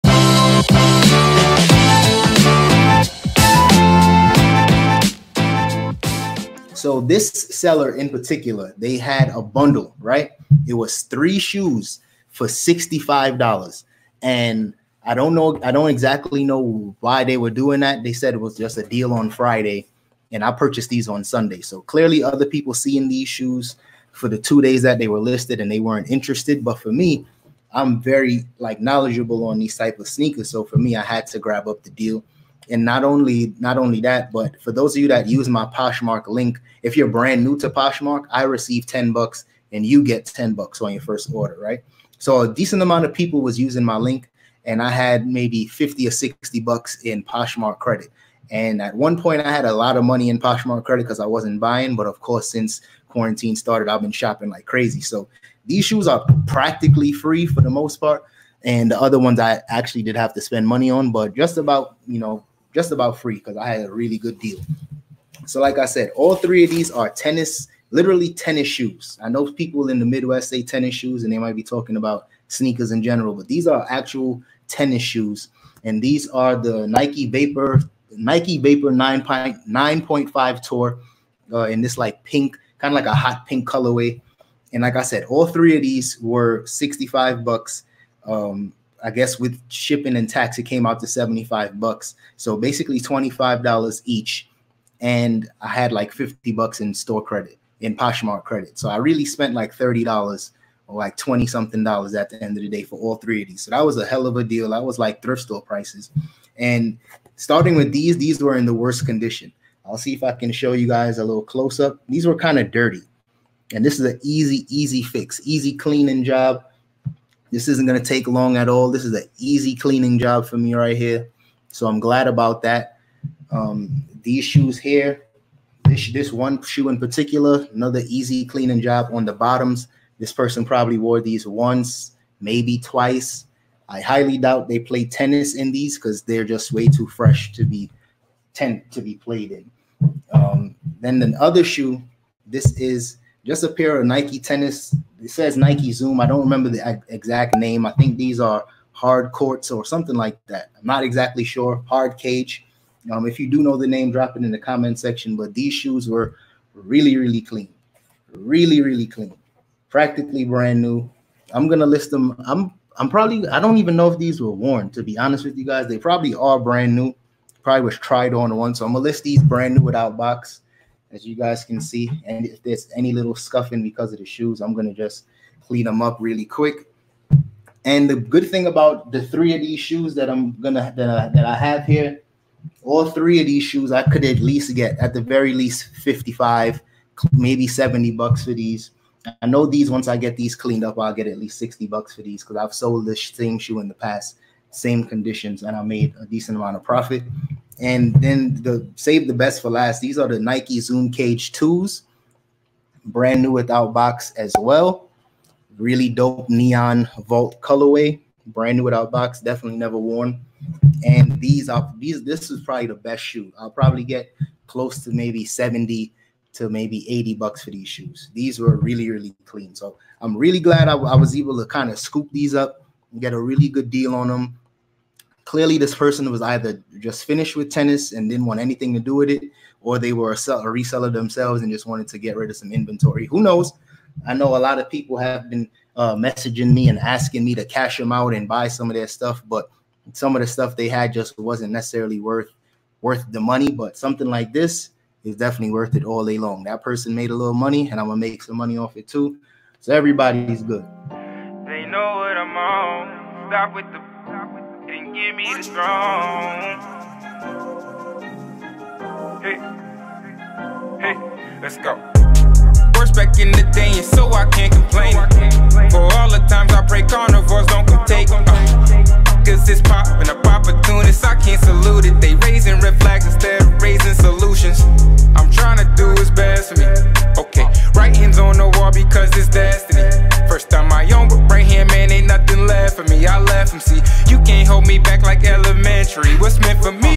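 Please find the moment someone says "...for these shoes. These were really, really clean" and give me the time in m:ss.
3:37.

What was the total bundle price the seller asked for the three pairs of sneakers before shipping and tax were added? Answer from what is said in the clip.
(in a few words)
$65.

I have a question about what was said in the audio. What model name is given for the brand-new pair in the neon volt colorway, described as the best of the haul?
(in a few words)
Nike Zoom Cage 2.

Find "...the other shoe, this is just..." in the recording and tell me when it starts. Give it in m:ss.
2:21.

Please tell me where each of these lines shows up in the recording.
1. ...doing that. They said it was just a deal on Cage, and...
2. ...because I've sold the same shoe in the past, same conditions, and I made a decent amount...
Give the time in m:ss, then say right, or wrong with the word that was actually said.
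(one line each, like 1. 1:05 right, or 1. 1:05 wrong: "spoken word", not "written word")
1. 0:17 wrong: "Friday", not "Cage"
2. 3:12 right.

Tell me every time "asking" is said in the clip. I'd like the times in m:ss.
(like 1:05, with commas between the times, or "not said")
3:56.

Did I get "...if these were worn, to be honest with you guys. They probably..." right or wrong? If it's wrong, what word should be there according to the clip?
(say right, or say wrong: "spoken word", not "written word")
right.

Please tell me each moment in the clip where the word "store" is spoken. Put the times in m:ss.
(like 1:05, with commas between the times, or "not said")
1:36, 1:45.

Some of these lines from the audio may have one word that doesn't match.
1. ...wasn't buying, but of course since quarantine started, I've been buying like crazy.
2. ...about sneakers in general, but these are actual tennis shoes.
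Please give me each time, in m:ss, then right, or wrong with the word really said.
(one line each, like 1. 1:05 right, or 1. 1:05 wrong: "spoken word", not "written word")
1. 0:51 wrong: "shopping", not "buying"
2. 1:11 right.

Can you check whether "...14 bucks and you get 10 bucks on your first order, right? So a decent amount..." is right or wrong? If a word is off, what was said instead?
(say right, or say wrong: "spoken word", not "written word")
wrong: "10", not "14".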